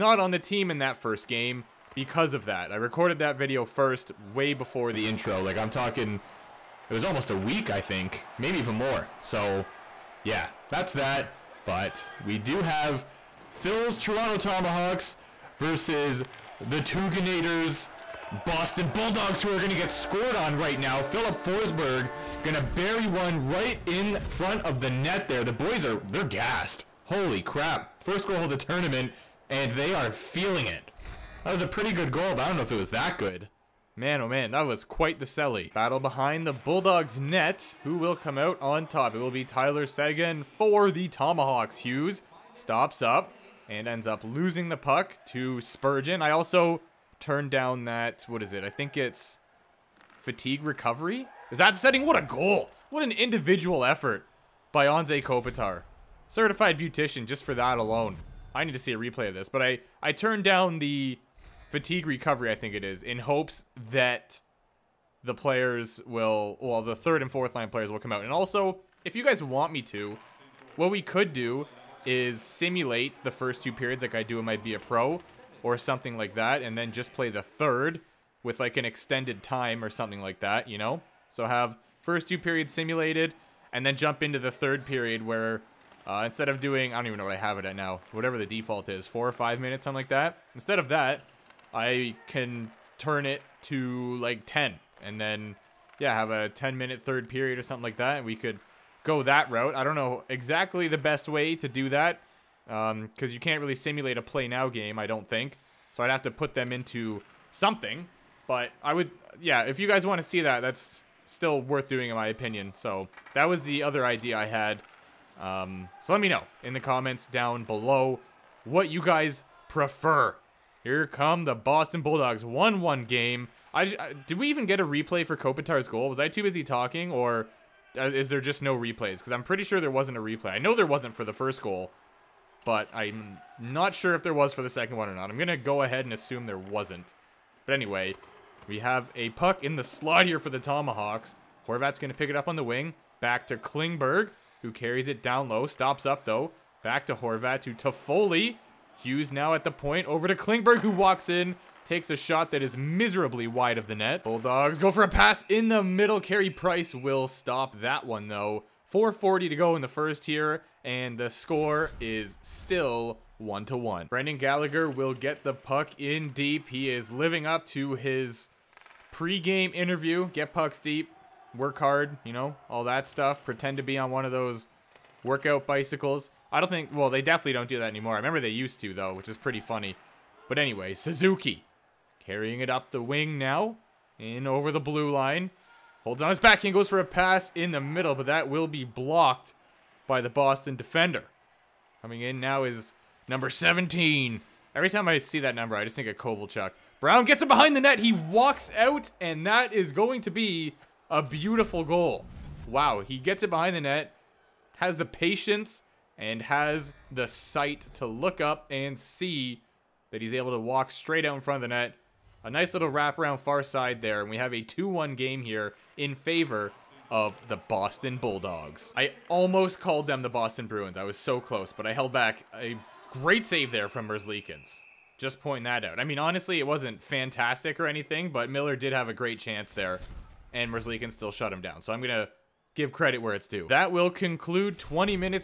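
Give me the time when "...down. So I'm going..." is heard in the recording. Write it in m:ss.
3:51.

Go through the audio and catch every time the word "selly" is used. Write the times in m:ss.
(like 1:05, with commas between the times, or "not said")
0:35.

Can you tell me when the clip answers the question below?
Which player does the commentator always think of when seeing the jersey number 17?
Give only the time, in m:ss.
3:16.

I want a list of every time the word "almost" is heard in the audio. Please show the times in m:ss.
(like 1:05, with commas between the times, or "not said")
0:07, 3:39.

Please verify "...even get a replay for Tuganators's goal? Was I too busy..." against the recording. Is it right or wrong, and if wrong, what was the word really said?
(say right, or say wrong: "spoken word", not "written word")
wrong: "Kopitar", not "Tuganators".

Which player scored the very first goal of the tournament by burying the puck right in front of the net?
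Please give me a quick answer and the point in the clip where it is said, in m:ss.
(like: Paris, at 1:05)
Filip Forsberg, at 0:21.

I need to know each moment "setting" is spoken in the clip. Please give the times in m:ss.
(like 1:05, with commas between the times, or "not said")
0:51.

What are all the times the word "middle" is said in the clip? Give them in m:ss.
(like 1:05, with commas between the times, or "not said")
2:35, 3:07.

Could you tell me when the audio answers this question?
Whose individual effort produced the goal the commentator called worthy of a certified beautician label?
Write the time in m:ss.
0:54.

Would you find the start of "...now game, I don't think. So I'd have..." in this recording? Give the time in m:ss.
1:44.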